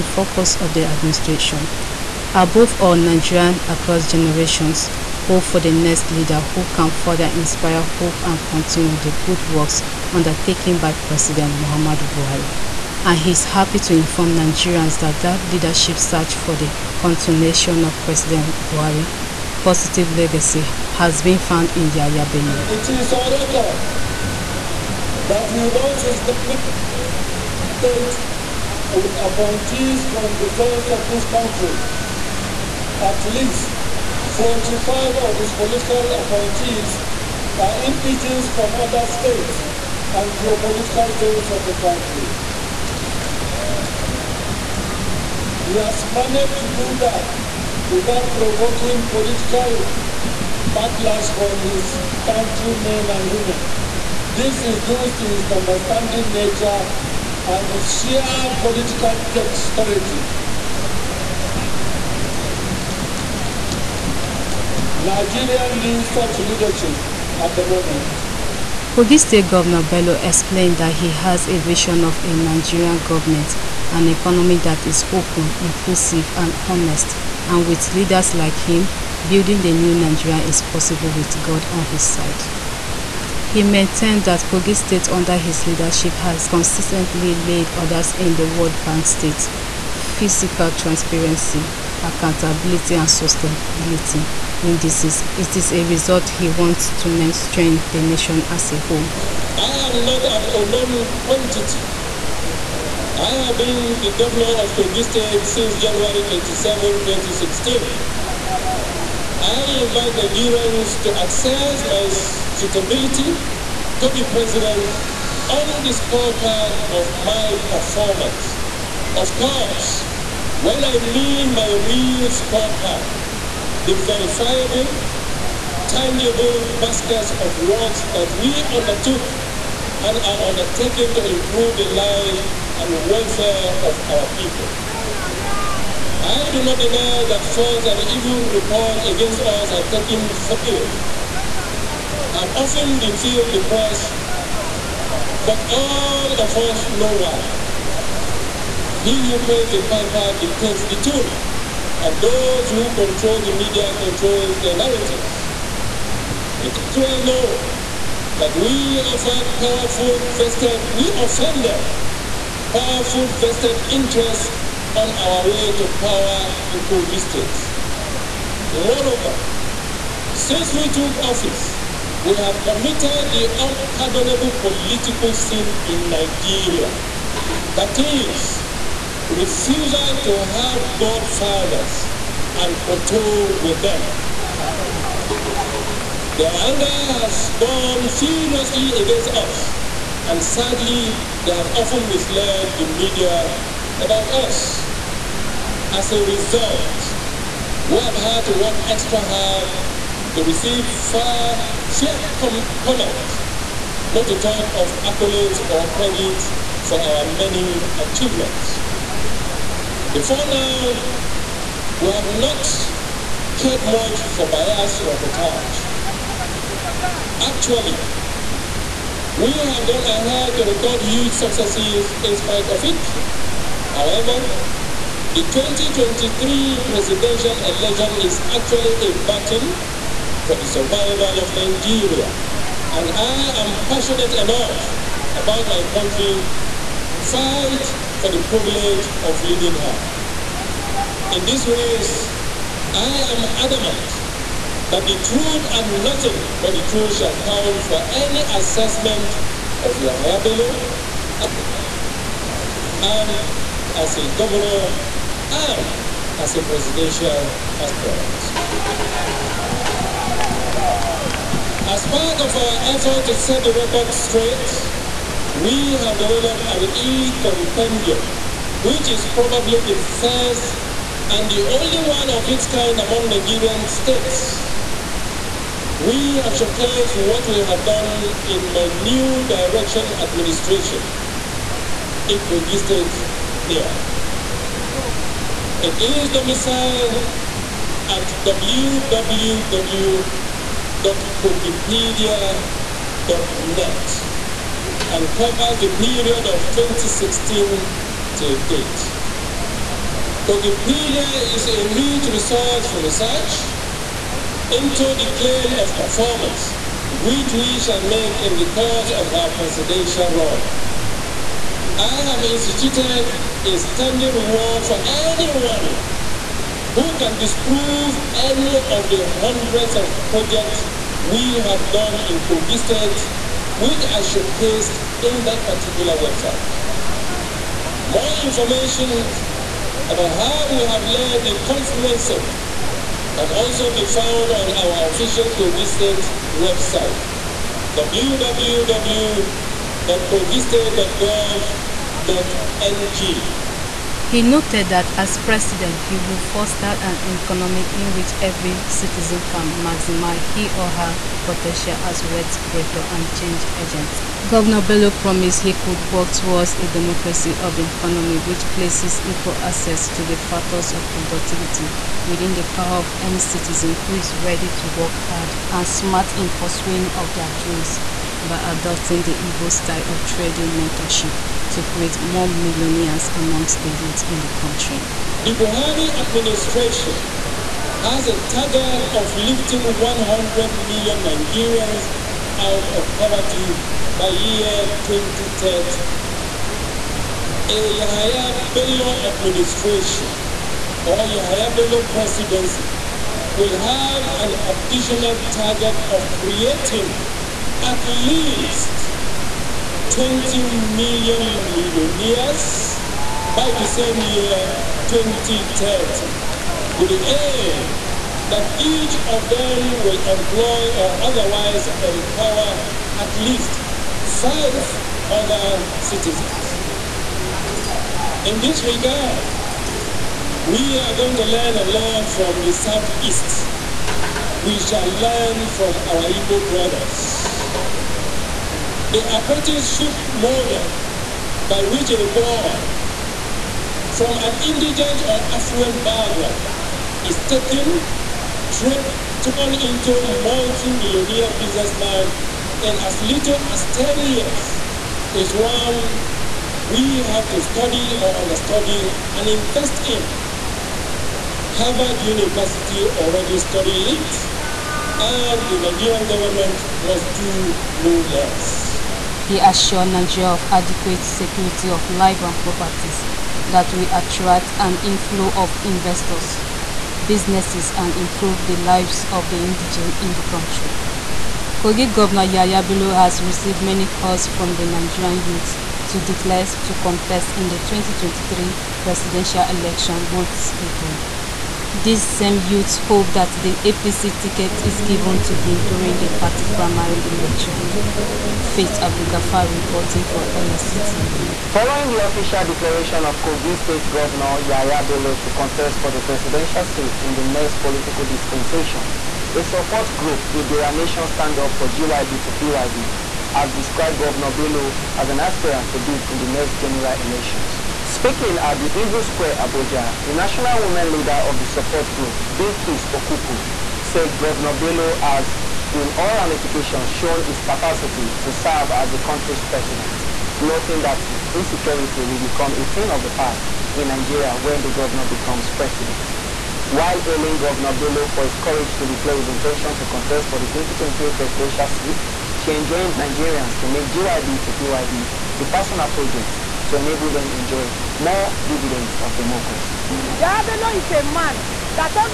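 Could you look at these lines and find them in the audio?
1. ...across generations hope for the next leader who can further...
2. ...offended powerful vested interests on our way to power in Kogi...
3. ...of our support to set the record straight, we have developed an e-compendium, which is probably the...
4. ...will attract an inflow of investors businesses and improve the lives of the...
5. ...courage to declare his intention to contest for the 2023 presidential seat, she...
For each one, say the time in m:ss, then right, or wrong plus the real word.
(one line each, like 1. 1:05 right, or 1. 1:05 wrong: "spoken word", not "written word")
1. 0:03 right
2. 2:41 right
3. 4:22 wrong: "effort", not "support"
4. 7:43 right
5. 8:48 right.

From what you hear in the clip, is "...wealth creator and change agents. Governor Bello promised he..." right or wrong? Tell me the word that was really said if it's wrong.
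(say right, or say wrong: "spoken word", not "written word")
right.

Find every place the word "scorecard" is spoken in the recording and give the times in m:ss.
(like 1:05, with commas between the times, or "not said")
1:55, 2:02.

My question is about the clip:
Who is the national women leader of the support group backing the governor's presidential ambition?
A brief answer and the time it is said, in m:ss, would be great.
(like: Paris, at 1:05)
Bilkis Okuku, at 8:32.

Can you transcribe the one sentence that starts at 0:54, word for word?
This is due to his understanding nature and his sheer political dexterity.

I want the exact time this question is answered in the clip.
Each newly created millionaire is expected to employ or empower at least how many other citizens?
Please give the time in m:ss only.
6:54.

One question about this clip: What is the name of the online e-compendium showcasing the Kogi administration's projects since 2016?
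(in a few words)
Kogipedia.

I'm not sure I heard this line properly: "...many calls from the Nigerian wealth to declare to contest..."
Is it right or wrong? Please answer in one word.
wrong.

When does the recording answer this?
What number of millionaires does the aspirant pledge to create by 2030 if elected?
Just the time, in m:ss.
6:40.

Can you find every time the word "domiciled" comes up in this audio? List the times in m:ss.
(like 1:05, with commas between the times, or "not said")
4:46.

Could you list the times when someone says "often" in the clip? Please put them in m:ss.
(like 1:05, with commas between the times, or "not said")
2:22, 3:11.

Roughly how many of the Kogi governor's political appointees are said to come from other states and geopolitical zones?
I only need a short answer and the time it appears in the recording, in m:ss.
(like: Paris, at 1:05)
45, at 0:34.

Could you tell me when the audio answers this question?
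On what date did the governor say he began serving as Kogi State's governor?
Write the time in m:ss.
1:45.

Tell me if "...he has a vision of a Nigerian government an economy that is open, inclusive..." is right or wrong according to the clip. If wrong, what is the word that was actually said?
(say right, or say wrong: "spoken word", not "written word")
right.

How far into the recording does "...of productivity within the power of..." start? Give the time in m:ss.
6:00.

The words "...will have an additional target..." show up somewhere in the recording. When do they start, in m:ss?
6:33.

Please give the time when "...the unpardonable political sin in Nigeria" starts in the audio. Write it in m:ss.
2:53.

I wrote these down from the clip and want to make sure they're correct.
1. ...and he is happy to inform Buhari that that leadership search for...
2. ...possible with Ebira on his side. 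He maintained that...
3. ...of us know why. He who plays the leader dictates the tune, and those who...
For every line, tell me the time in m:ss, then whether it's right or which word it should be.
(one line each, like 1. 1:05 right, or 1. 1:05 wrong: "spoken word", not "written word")
1. 0:13 wrong: "Nigerians", not "Buhari"
2. 1:20 wrong: "God", not "Ebira"
3. 2:26 wrong: "piper", not "leader".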